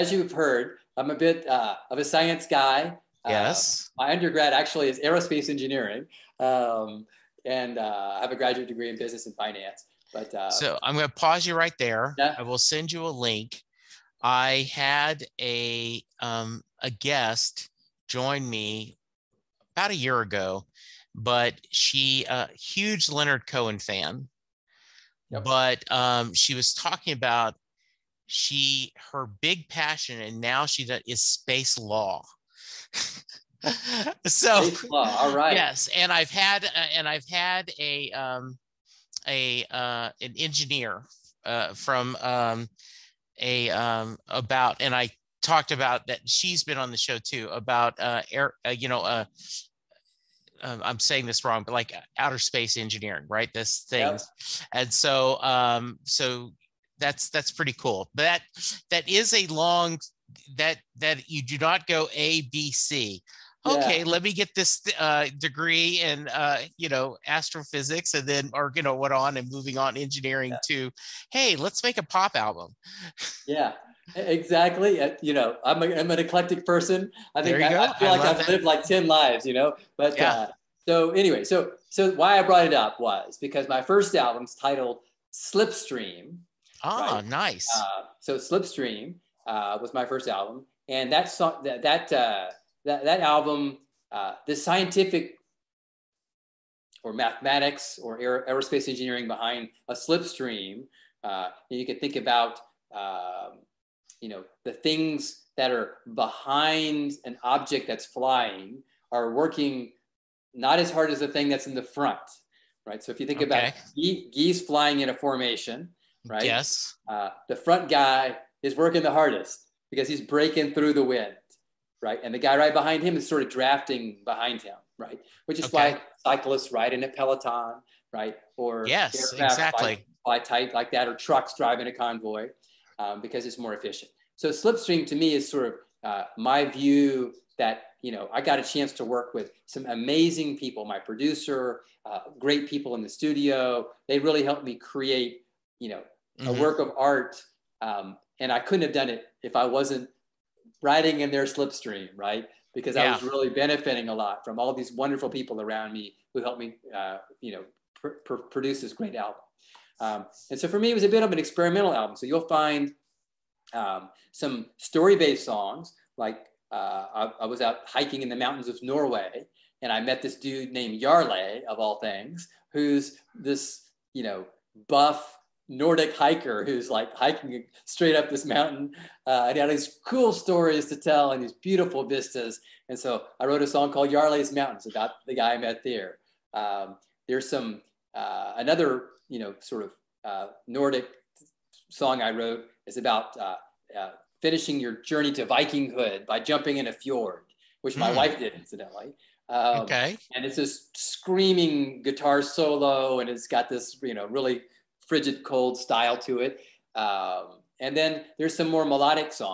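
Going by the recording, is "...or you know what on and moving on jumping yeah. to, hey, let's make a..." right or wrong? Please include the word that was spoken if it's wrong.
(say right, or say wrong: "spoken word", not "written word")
wrong: "engineering", not "jumping".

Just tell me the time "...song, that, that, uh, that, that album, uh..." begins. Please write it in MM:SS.
01:31.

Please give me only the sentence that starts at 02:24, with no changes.
They really helped me create you know mm-hmm.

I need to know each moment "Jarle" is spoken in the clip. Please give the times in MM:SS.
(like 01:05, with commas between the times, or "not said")
02:51, 03:04.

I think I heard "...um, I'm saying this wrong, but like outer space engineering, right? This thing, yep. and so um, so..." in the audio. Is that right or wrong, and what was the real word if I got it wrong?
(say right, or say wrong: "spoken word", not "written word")
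right.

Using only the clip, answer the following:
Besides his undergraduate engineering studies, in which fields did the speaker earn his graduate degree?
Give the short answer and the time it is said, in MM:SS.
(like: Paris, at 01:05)
Business and finance, at 00:08.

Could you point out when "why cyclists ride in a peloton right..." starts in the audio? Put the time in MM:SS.
02:05.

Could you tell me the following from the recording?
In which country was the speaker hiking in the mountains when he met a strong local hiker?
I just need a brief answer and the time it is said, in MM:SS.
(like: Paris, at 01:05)
Norway, at 02:48.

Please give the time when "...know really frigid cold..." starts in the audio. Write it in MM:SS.
03:24.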